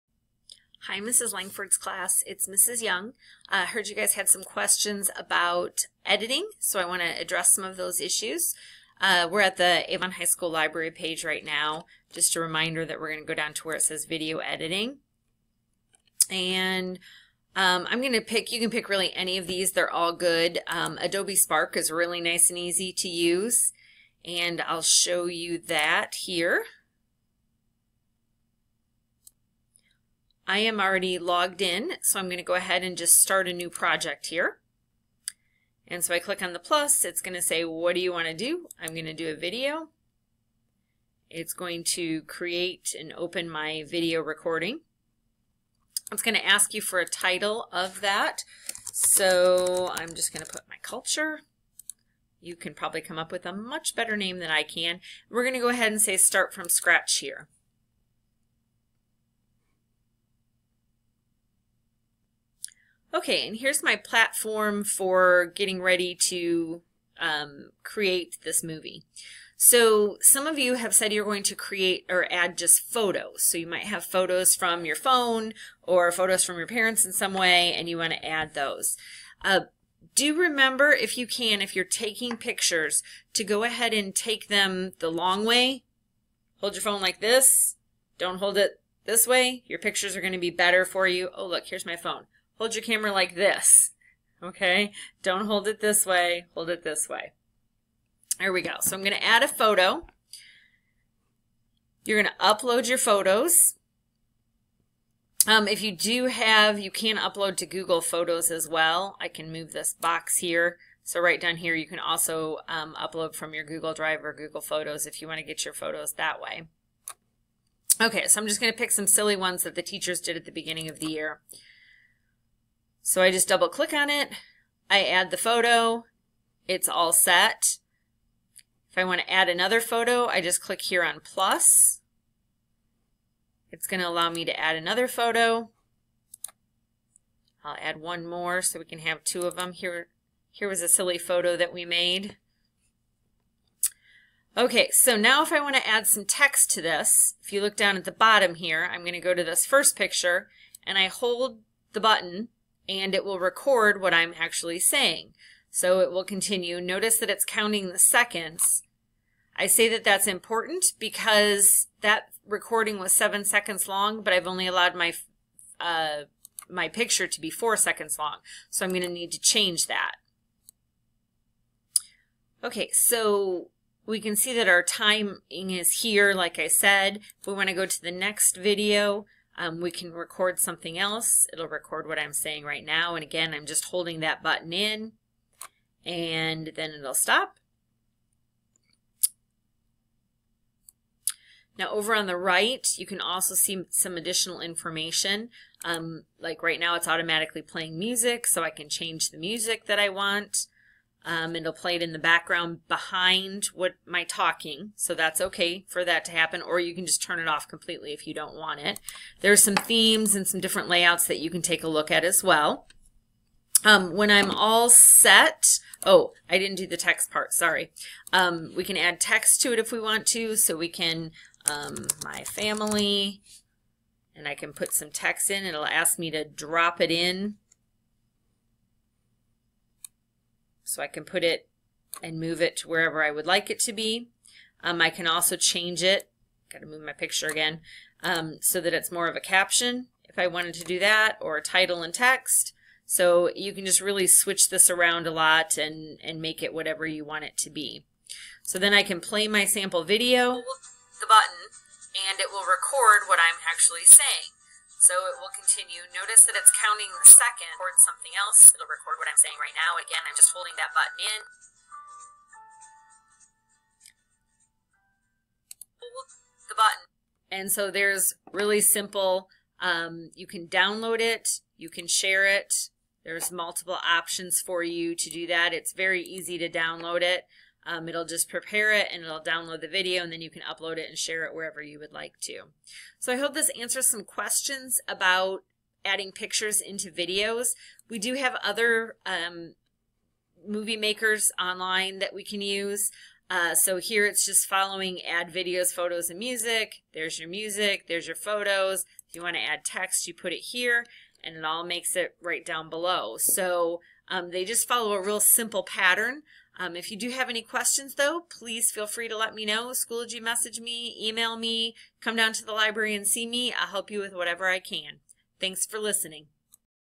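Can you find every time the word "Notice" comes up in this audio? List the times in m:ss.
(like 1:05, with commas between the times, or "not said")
2:36, 4:16.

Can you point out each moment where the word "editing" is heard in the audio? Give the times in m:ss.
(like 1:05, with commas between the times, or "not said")
0:06, 0:14.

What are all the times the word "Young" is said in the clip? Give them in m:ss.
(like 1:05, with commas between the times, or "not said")
0:02.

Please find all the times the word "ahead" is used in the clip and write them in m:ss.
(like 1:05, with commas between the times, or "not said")
0:32, 0:55, 1:23.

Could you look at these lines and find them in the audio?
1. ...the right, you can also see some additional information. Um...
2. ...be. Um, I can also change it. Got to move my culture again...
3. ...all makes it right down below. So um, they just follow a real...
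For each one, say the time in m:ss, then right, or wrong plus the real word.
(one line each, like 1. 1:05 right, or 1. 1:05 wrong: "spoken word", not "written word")
1. 3:12 right
2. 3:53 wrong: "picture", not "culture"
3. 5:01 right.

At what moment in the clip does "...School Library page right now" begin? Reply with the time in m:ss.
0:10.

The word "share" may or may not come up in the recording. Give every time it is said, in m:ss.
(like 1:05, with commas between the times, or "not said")
4:32, 4:41.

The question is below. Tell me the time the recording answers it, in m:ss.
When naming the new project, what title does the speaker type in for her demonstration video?
0:50.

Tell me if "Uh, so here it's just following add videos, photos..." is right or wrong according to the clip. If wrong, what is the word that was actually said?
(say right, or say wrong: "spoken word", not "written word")
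right.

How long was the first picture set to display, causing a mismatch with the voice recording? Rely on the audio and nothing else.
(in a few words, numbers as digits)
4 seconds.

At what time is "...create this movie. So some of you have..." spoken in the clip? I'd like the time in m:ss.
1:07.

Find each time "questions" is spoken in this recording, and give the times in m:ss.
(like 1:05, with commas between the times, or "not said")
0:04, 4:44, 5:07.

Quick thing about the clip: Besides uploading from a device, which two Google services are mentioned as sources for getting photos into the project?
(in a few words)
Google Drive or Google Photos.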